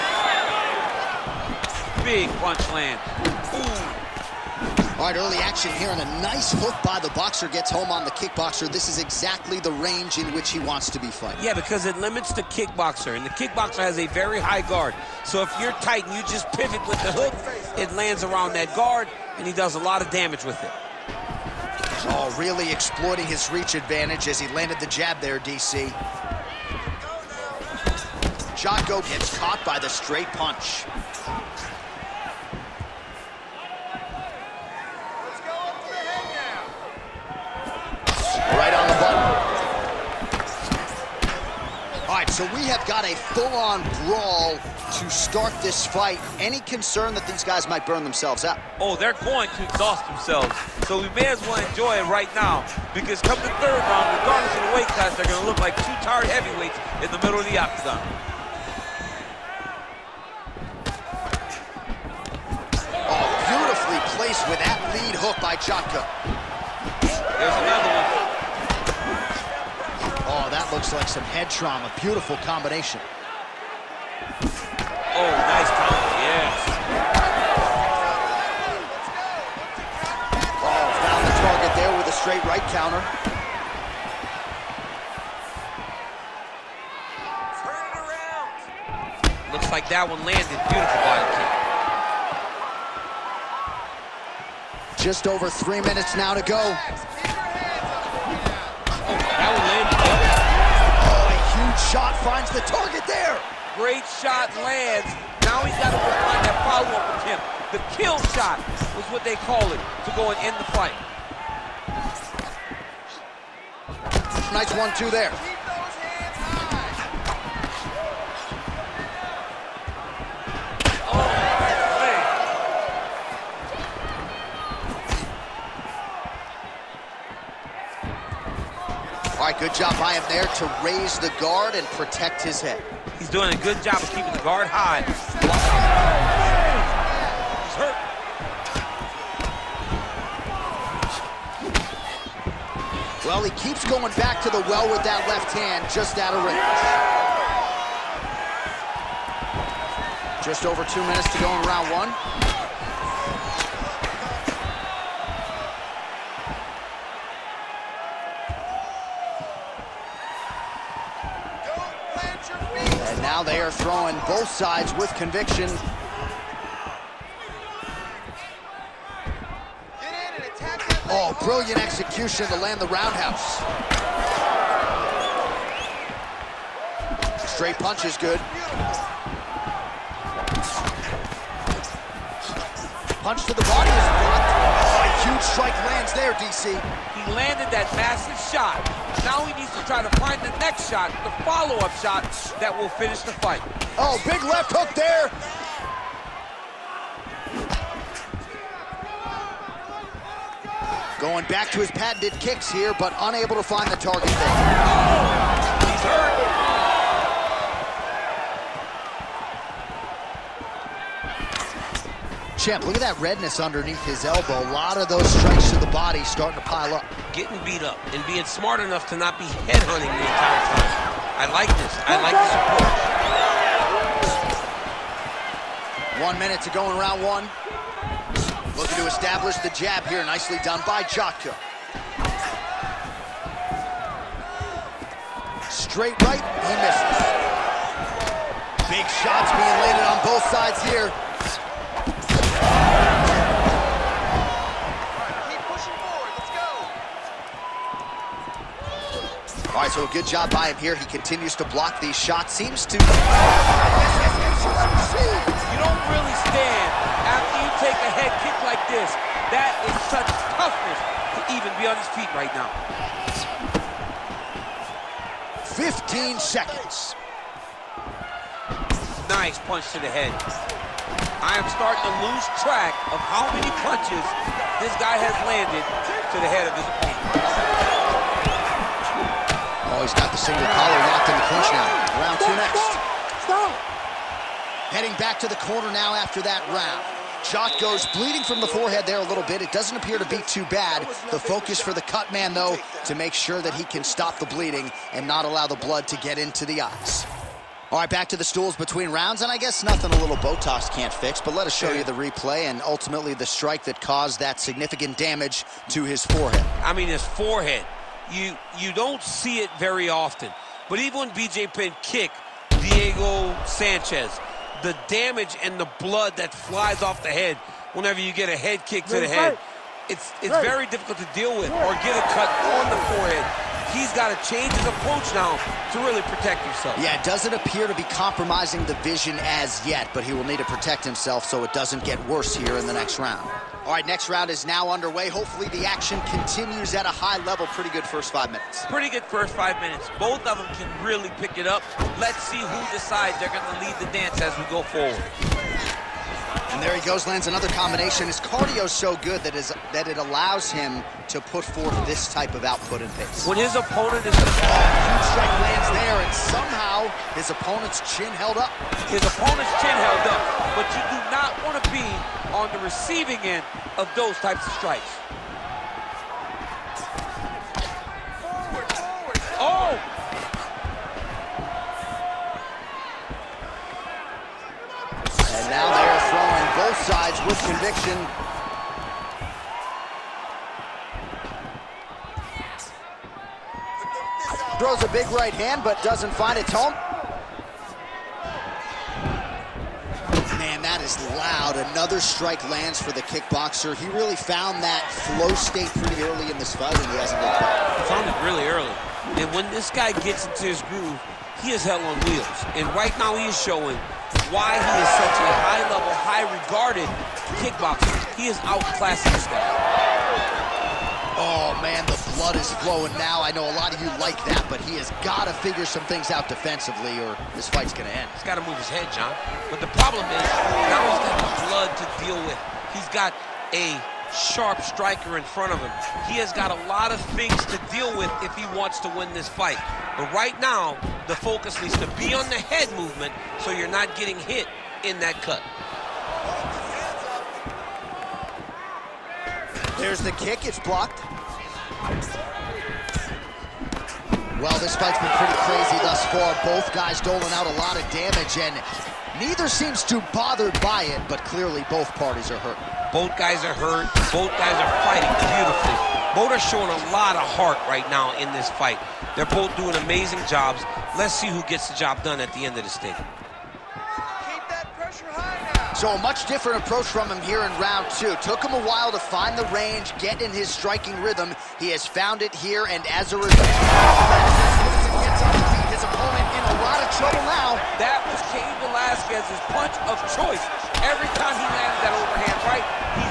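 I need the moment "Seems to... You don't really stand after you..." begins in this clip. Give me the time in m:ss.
4:12.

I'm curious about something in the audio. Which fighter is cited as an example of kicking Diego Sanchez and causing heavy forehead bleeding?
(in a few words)
BJ Penn.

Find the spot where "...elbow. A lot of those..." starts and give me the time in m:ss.
3:34.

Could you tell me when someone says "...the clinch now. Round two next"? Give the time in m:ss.
4:41.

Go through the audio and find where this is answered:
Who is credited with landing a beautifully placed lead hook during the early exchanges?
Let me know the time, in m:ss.
1:05.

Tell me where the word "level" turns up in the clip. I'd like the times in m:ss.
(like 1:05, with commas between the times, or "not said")
5:37, 6:45.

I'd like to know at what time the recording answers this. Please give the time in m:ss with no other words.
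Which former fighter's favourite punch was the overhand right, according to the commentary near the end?
7:58.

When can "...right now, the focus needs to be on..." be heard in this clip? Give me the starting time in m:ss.
7:10.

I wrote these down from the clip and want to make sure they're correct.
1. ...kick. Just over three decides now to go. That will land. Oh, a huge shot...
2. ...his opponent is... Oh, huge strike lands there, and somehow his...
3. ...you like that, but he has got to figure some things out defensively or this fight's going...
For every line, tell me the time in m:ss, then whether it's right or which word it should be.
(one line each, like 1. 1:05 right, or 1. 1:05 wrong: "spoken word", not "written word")
1. 1:34 wrong: "minutes", not "decides"
2. 5:53 right
3. 6:54 right.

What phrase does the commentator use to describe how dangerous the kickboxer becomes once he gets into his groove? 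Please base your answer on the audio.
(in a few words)
hell on wheels.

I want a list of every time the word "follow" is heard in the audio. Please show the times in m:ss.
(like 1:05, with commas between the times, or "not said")
1:46, 3:11.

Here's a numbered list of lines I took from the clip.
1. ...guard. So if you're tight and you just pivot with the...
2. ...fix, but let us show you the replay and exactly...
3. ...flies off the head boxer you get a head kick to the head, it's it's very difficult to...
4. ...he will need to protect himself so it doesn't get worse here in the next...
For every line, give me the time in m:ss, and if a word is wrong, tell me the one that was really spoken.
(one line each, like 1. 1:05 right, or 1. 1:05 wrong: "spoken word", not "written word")
1. 0:14 right
2. 5:01 wrong: "ultimately", not "exactly"
3. 5:16 wrong: "whenever", not "boxer"
4. 5:30 right.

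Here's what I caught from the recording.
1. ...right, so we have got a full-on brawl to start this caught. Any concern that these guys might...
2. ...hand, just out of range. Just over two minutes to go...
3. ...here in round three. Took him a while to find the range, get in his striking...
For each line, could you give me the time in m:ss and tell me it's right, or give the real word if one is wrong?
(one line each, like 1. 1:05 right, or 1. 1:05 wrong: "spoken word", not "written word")
1. 0:42 wrong: "fight", not "caught"
2. 2:25 right
3. 7:47 wrong: "two", not "three".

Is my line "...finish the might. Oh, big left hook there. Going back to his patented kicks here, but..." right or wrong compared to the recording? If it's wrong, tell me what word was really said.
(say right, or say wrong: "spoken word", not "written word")
wrong: "fight", not "might".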